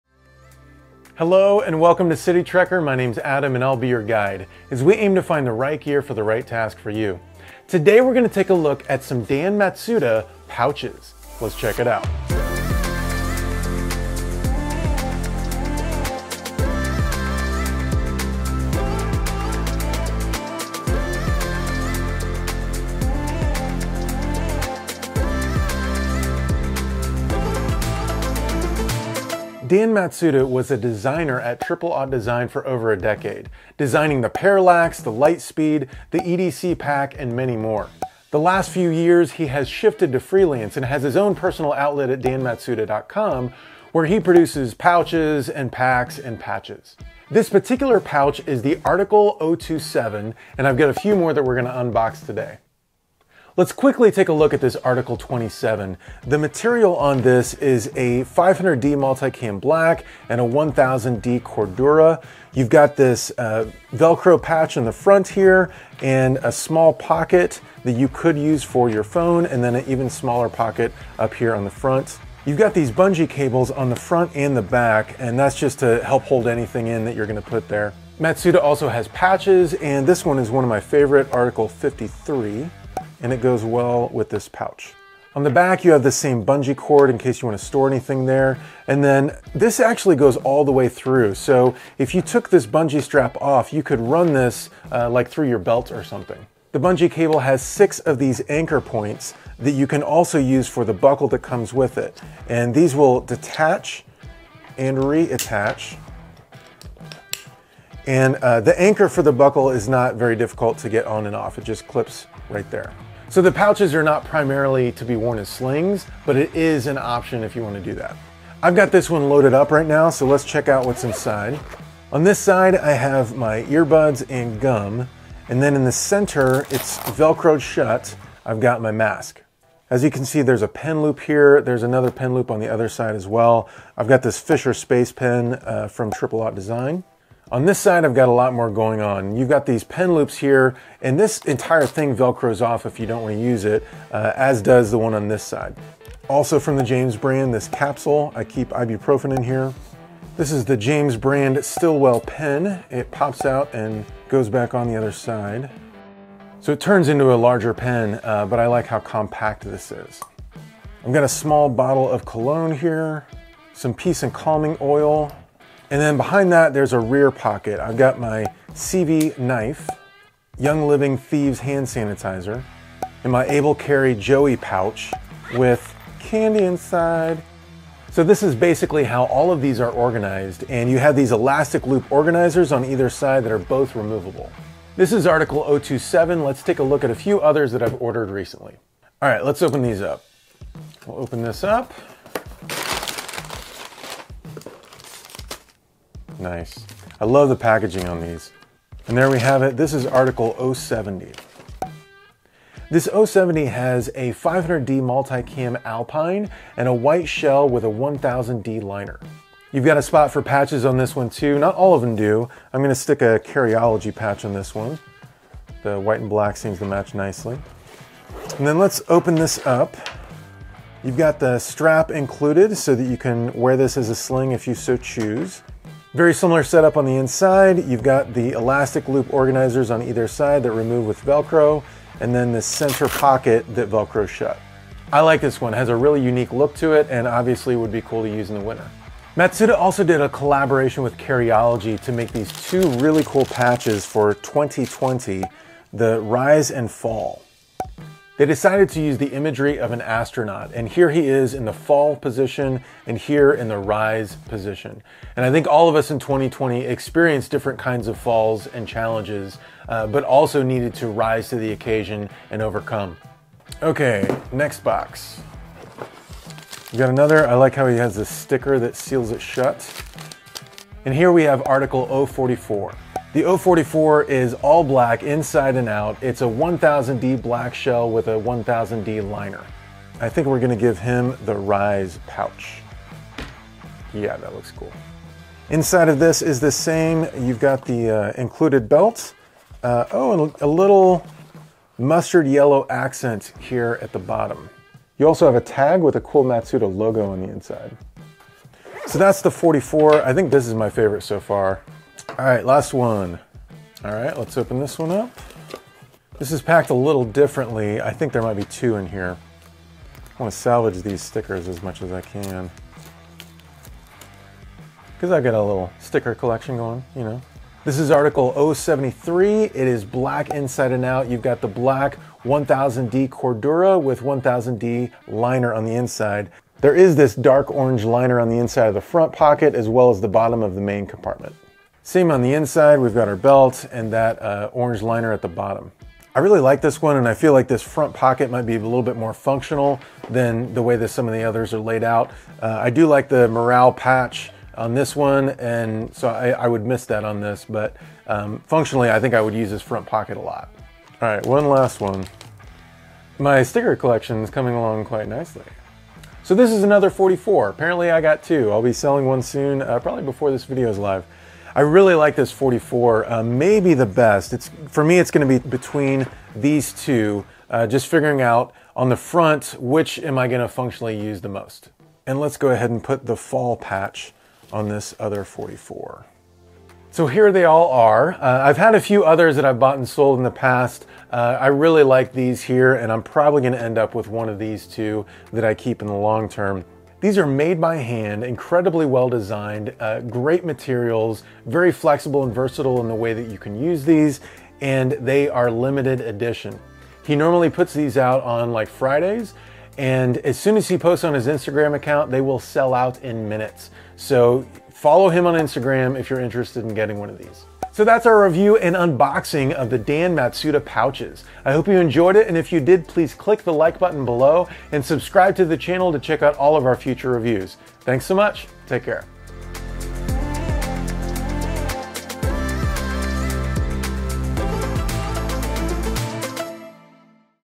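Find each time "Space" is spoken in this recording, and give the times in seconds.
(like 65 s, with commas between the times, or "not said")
134 s.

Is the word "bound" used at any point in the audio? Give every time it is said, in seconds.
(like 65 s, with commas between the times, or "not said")
not said.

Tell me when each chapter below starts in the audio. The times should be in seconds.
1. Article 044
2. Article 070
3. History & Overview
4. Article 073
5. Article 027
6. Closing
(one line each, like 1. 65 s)
1. 263 s
2. 189 s
3. 29 s
4. 302 s
5. 52 s
6. 376 s.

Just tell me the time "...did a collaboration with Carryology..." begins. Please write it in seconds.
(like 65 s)
240 s.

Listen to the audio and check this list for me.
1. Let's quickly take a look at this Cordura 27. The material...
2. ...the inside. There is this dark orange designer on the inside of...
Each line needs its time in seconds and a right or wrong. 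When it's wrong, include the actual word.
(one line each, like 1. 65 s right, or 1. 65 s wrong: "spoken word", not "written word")
1. 53 s wrong: "Article", not "Cordura"
2. 325 s wrong: "liner", not "designer".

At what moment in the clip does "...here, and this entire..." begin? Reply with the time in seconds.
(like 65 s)
140 s.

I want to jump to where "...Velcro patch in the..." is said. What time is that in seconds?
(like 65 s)
63 s.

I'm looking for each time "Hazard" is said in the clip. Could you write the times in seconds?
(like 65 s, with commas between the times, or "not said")
not said.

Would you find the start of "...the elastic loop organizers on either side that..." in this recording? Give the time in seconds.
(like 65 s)
228 s.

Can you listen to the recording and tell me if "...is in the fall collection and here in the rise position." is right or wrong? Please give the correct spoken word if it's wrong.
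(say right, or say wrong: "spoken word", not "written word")
wrong: "position", not "collection".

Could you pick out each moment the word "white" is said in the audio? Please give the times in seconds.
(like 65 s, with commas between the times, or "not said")
206 s, 215 s.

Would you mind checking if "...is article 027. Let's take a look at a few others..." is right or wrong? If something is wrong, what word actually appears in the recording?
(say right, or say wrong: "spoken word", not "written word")
right.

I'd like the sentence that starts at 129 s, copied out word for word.
As you can see, there's a pen loop here.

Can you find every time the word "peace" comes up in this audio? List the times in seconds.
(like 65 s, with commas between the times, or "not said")
163 s.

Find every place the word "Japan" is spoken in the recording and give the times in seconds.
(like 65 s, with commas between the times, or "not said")
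not said.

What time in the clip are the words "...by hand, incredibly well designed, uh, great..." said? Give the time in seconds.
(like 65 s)
387 s.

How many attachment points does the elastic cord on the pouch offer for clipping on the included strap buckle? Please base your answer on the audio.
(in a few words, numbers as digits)
6.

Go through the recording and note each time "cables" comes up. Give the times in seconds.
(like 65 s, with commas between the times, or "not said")
73 s, 97 s.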